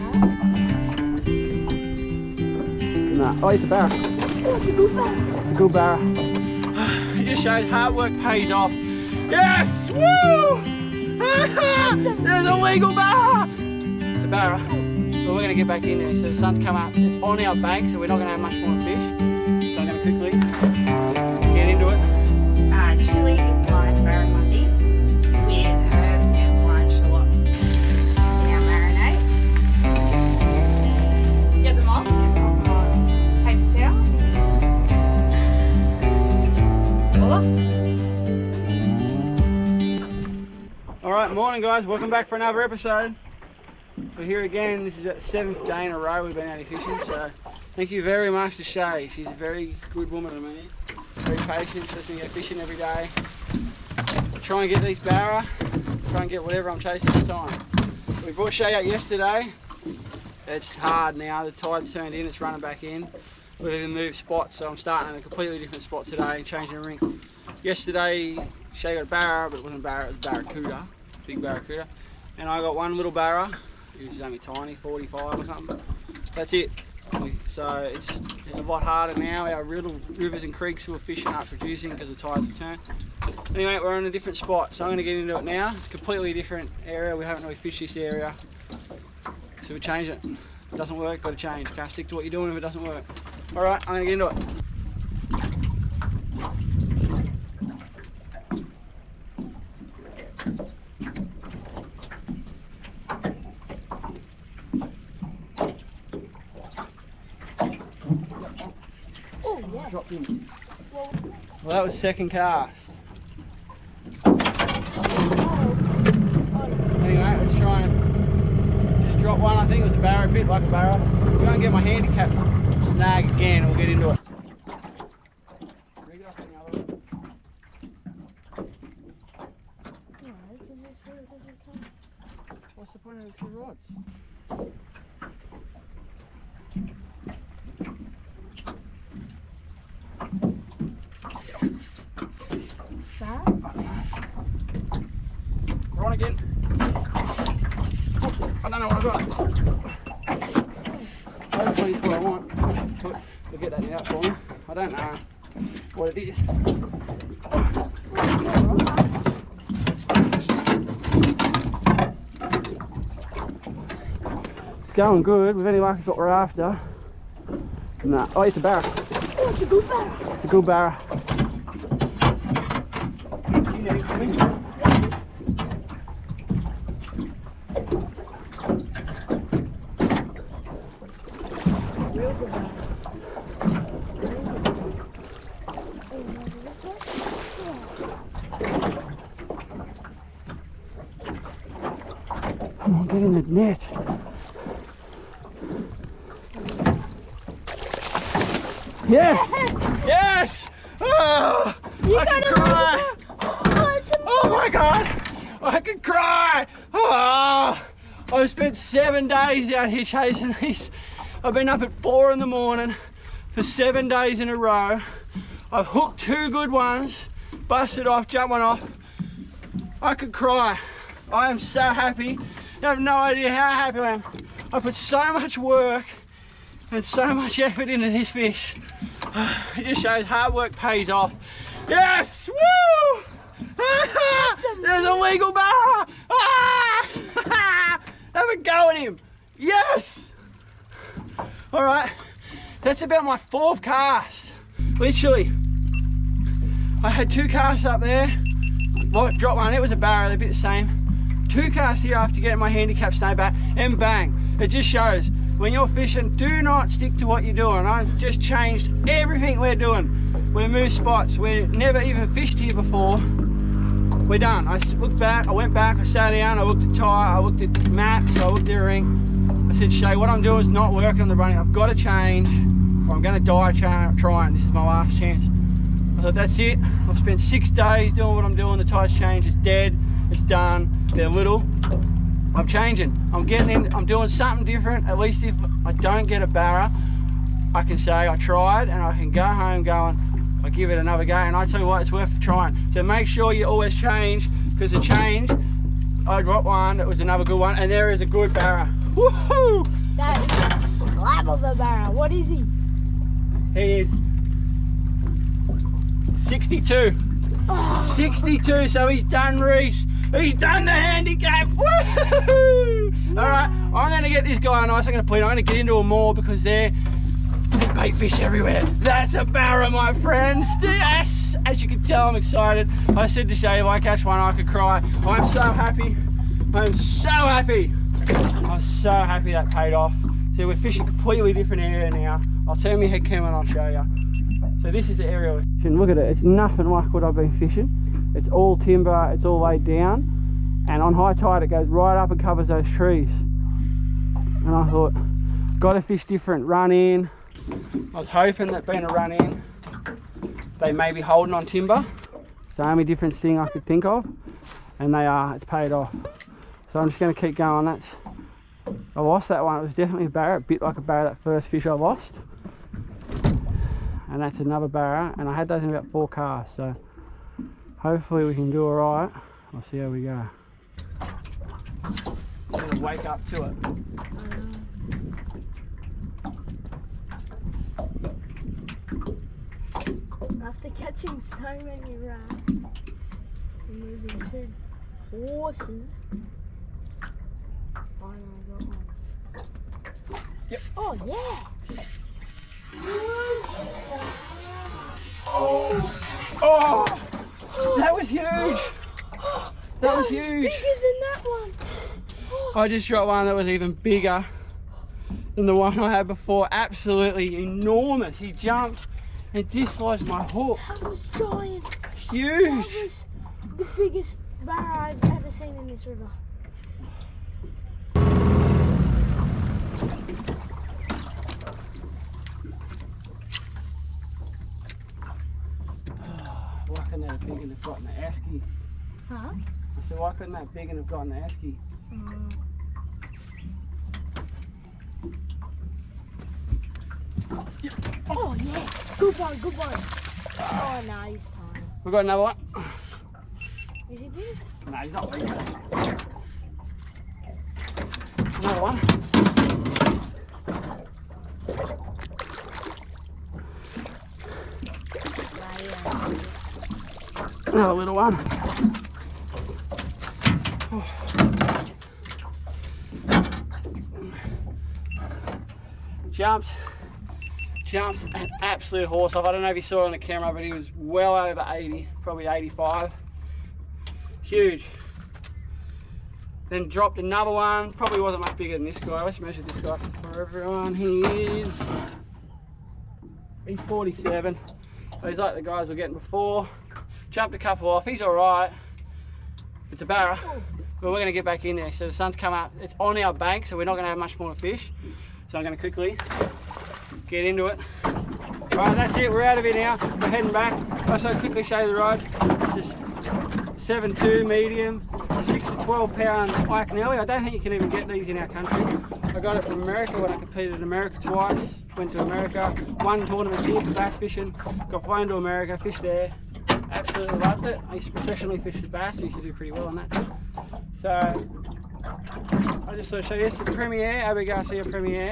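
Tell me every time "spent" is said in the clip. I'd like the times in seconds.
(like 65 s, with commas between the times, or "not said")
208 s, 277 s.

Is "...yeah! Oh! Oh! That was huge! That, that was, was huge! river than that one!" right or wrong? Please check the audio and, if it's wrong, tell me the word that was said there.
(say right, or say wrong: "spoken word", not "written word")
wrong: "bigger", not "river".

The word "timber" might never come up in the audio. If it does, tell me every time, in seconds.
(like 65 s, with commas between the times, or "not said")
338 s, 351 s.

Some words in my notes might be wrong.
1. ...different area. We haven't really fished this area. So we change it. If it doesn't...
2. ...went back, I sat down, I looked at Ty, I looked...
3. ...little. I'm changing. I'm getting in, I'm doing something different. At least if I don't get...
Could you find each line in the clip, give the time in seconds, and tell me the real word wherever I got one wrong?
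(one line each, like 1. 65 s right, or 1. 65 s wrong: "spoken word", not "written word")
1. 86 s right
2. 265 s right
3. 281 s right.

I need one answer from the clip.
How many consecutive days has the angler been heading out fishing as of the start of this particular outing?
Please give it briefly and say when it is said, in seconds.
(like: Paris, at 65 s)
7, at 45 s.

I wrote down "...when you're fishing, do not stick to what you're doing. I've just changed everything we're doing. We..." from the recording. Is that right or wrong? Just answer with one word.
right.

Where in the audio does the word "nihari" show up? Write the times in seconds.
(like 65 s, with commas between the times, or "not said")
not said.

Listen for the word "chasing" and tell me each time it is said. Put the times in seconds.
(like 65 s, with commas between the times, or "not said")
56 s, 210 s.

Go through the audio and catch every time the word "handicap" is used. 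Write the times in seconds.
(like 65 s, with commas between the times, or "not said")
121 s, 252 s, 310 s.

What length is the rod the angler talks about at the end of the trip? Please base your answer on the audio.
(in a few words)
7.2.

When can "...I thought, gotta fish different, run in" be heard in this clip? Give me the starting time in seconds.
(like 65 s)
344 s.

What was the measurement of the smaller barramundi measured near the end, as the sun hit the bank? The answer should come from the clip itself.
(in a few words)
47.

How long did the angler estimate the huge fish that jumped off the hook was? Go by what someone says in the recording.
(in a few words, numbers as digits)
85.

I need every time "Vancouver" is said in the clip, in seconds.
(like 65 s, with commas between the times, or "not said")
not said.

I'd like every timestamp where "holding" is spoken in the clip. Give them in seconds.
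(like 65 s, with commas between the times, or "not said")
351 s.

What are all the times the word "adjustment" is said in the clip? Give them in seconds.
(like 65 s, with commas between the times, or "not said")
not said.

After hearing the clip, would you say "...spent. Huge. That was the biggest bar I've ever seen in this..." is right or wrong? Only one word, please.
wrong.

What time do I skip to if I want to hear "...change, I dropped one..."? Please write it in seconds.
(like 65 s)
294 s.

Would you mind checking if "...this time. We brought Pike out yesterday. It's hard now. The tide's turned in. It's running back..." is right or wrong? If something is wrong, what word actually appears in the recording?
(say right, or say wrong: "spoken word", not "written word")
wrong: "Shay", not "Pike".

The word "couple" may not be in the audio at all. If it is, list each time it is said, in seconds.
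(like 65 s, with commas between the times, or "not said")
487 s.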